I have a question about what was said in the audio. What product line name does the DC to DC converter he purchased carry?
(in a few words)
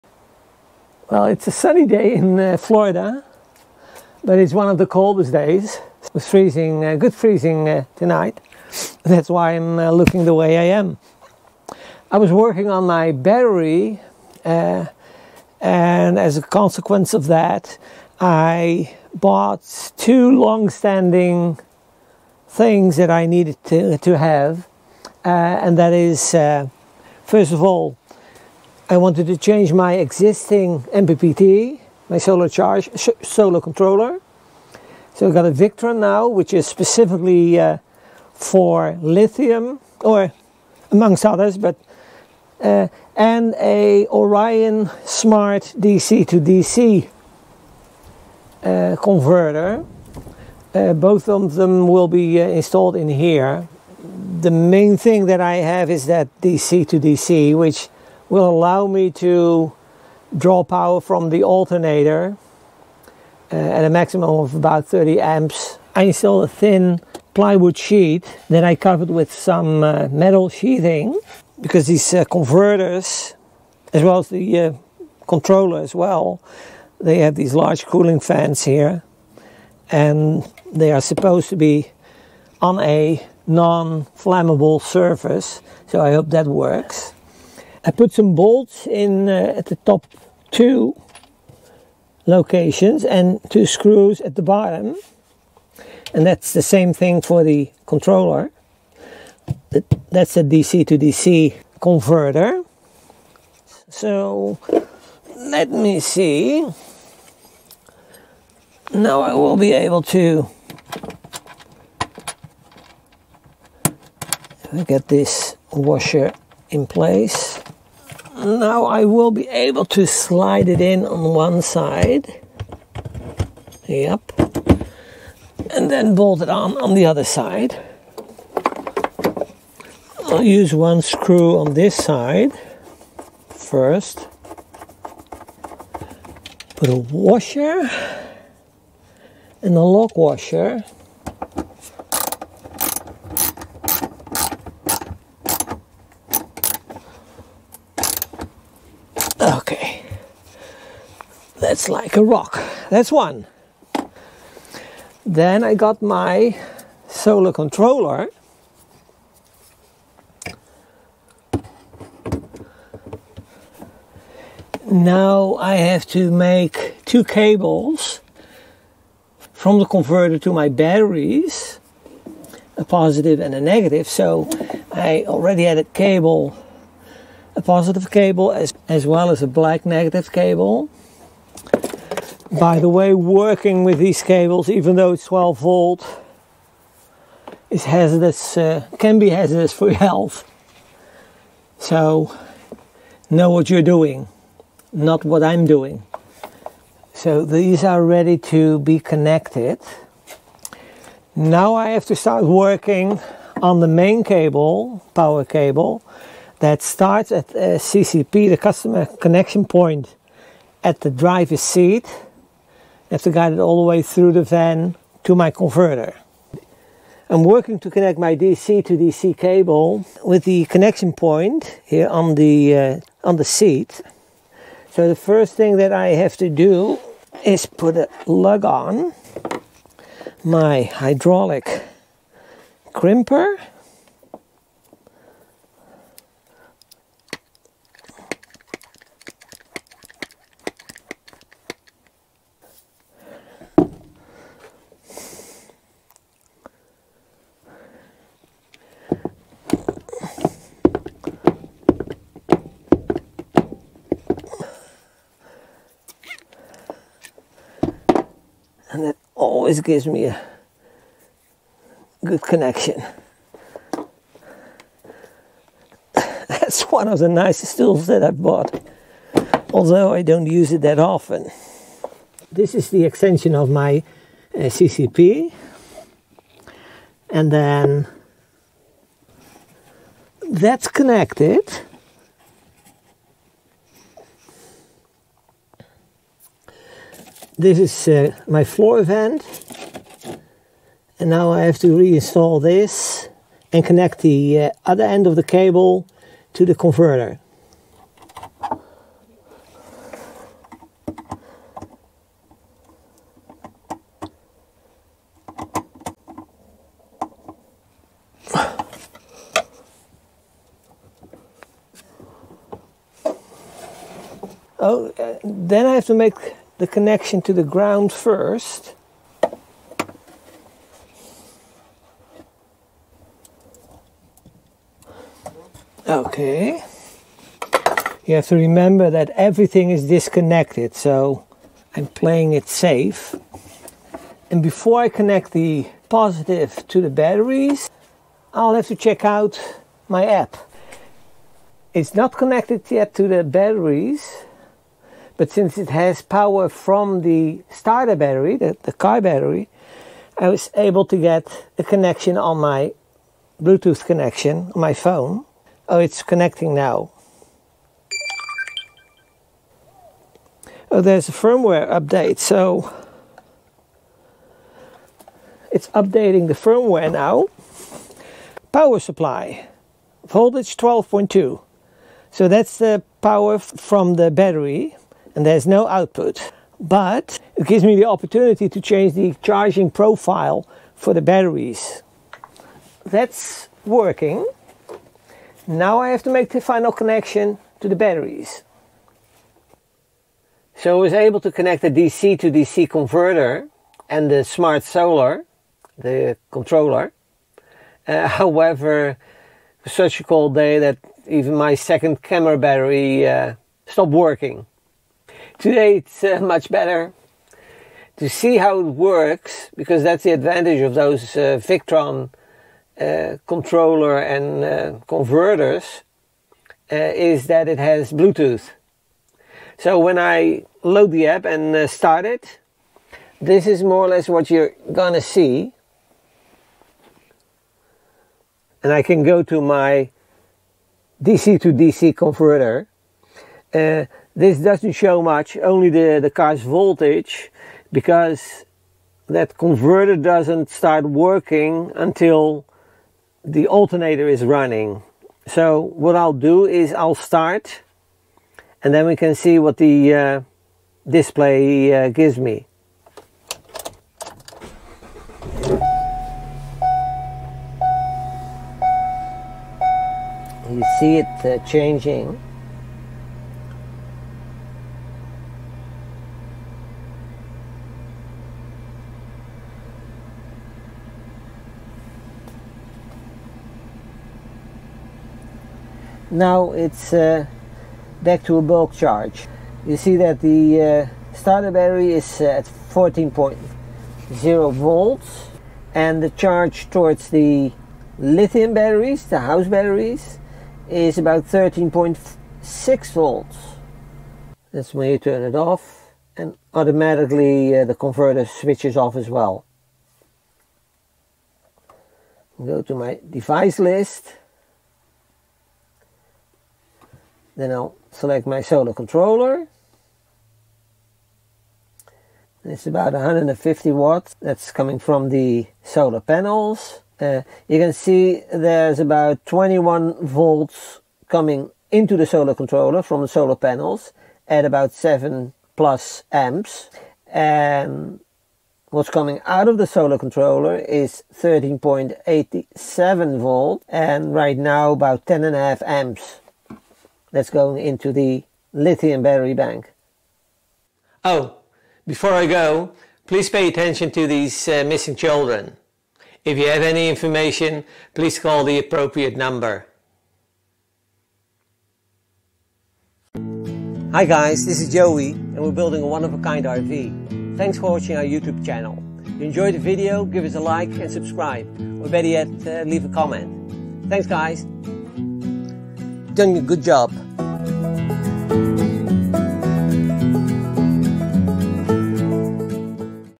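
Orion Smart.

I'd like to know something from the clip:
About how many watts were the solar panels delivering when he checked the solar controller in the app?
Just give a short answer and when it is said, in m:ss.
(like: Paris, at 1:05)
150 watts, at 8:33.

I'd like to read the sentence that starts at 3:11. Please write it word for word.
So know what you're doing, not what I'm doing.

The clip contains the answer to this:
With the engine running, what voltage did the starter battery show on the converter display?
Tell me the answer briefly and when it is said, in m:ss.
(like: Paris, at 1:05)
14.0 volts, at 8:02.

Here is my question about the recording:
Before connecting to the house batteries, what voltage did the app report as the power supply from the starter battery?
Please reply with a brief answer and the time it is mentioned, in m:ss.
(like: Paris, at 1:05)
12.2, at 6:10.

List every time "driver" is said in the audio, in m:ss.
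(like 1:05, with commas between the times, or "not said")
3:31.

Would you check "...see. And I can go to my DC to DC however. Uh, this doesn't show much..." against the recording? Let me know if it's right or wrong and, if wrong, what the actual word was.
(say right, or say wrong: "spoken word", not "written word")
wrong: "converter", not "however".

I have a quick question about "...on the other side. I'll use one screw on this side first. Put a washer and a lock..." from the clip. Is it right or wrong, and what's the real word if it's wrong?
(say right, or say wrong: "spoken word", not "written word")
right.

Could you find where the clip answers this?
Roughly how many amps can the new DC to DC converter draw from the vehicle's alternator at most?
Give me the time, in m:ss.
1:04.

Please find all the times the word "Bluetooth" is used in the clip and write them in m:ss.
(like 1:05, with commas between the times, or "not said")
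5:53, 6:58.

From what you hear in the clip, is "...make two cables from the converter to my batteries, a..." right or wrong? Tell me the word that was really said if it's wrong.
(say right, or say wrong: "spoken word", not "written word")
right.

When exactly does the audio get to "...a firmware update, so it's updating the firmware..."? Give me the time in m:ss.
6:01.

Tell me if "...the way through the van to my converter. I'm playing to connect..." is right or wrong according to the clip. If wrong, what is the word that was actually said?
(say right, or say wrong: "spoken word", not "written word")
wrong: "working", not "playing".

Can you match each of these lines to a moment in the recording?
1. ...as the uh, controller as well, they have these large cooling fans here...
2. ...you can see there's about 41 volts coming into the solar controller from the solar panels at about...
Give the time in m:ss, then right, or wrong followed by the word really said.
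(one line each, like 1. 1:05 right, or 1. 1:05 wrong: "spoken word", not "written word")
1. 1:14 right
2. 8:37 wrong: "21", not "41".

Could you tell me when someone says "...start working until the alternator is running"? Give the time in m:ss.
7:20.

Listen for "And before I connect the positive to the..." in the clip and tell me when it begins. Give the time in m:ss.
5:34.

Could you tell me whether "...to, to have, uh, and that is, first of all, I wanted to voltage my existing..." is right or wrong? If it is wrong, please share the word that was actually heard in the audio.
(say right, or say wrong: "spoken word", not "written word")
wrong: "change", not "voltage".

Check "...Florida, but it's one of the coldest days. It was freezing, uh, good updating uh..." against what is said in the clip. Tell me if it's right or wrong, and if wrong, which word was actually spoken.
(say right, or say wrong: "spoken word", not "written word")
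wrong: "freezing", not "updating".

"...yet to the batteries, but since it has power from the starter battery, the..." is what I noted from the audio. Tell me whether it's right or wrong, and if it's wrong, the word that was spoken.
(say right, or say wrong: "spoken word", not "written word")
right.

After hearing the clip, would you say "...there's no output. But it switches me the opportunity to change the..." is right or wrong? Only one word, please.
wrong.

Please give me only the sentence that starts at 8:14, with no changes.
That's when you turn it off and automatically uh, the converter switches off as well.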